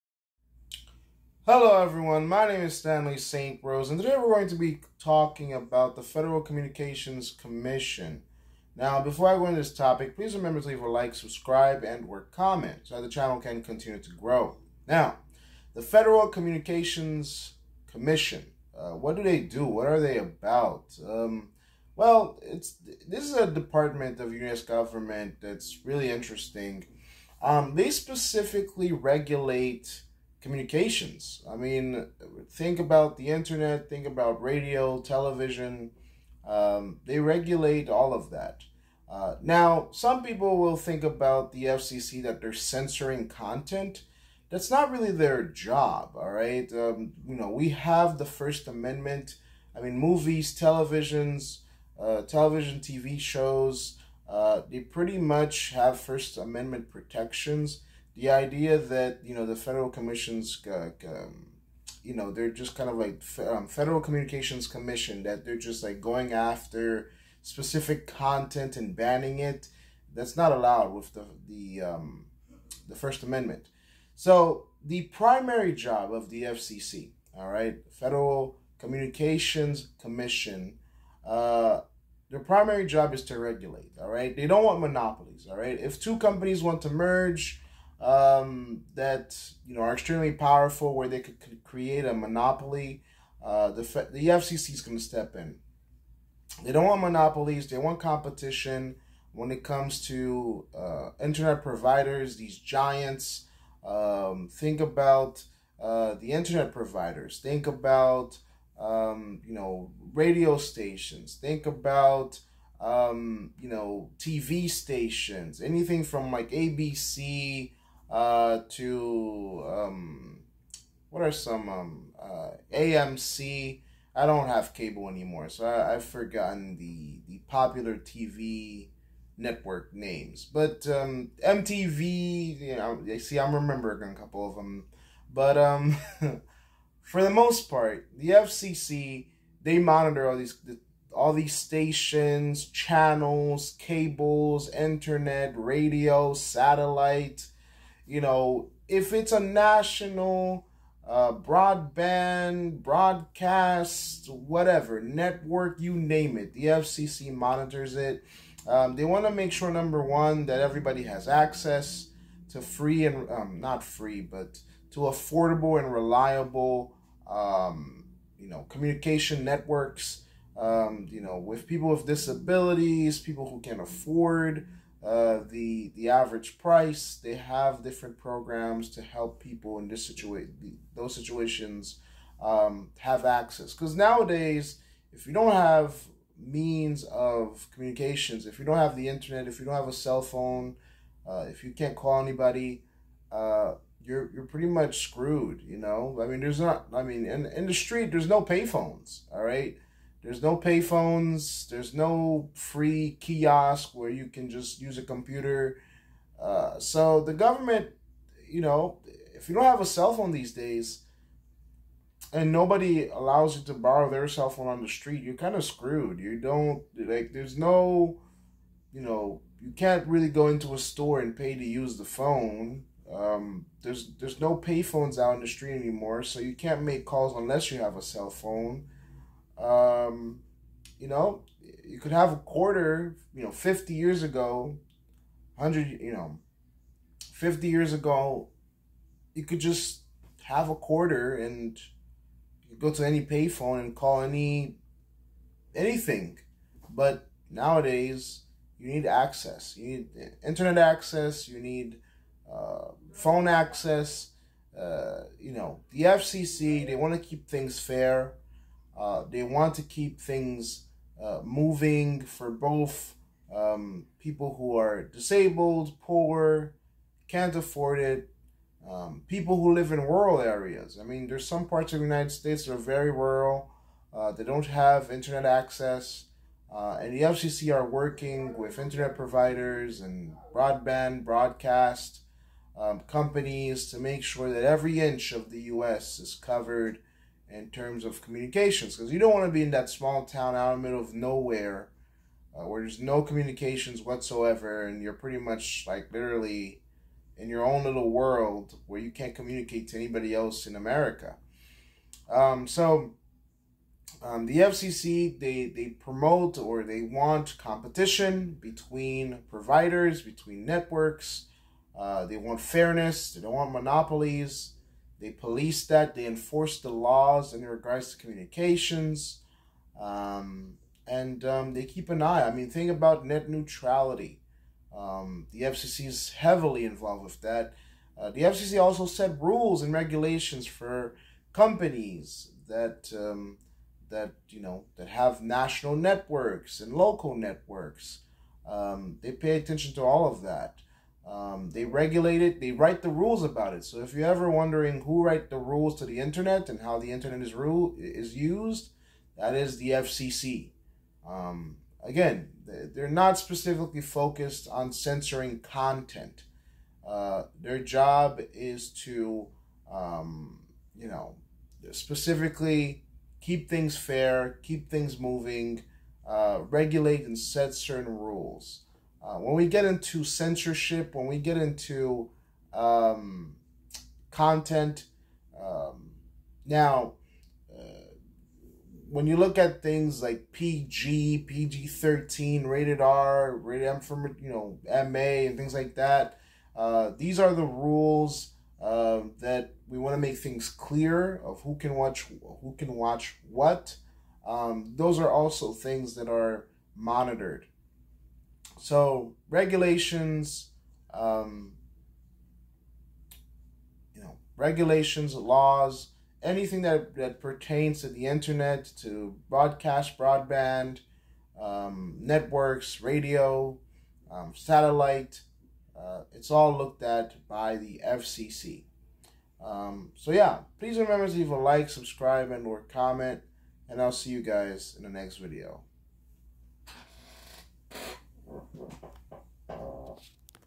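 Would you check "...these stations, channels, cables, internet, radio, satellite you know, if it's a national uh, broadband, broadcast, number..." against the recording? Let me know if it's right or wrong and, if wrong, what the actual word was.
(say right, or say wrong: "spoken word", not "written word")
wrong: "whatever", not "number".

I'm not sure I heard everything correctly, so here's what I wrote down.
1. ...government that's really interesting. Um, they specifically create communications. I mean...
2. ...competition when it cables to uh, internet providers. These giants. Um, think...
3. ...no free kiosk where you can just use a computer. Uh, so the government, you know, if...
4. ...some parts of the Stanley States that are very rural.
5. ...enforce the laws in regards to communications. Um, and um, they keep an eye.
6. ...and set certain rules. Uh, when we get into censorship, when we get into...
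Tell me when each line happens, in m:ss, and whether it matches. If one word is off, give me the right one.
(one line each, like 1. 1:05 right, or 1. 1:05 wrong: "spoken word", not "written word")
1. 0:24 wrong: "regulate", not "create"
2. 1:37 wrong: "comes", not "cables"
3. 3:21 right
4. 4:31 wrong: "United", not "Stanley"
5. 5:16 right
6. 6:07 right.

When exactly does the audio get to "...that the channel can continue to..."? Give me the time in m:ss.
0:12.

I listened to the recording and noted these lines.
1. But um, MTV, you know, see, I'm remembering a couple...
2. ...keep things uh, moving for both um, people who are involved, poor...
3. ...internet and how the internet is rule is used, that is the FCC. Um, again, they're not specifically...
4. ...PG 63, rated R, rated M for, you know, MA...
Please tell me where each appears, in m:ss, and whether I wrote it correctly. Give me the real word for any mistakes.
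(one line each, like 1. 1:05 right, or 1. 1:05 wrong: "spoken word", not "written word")
1. 2:10 right
2. 4:19 wrong: "disabled", not "involved"
3. 5:46 right
4. 6:21 wrong: "13", not "63".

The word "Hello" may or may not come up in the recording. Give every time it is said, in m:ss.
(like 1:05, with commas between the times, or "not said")
0:01.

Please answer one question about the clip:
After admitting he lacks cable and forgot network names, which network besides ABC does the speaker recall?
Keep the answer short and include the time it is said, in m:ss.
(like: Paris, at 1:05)
AMC, at 2:02.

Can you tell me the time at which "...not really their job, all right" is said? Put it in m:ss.
0:44.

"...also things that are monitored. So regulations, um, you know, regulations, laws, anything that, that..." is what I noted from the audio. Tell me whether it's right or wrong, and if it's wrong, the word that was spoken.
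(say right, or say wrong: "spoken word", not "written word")
right.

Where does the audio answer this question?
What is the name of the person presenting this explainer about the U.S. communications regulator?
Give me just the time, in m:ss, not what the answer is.
0:02.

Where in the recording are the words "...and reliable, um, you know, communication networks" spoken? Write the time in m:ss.
2:45.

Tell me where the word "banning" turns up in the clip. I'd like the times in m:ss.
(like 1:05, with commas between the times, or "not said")
1:08.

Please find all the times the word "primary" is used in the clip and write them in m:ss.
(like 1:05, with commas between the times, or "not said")
1:15, 1:22.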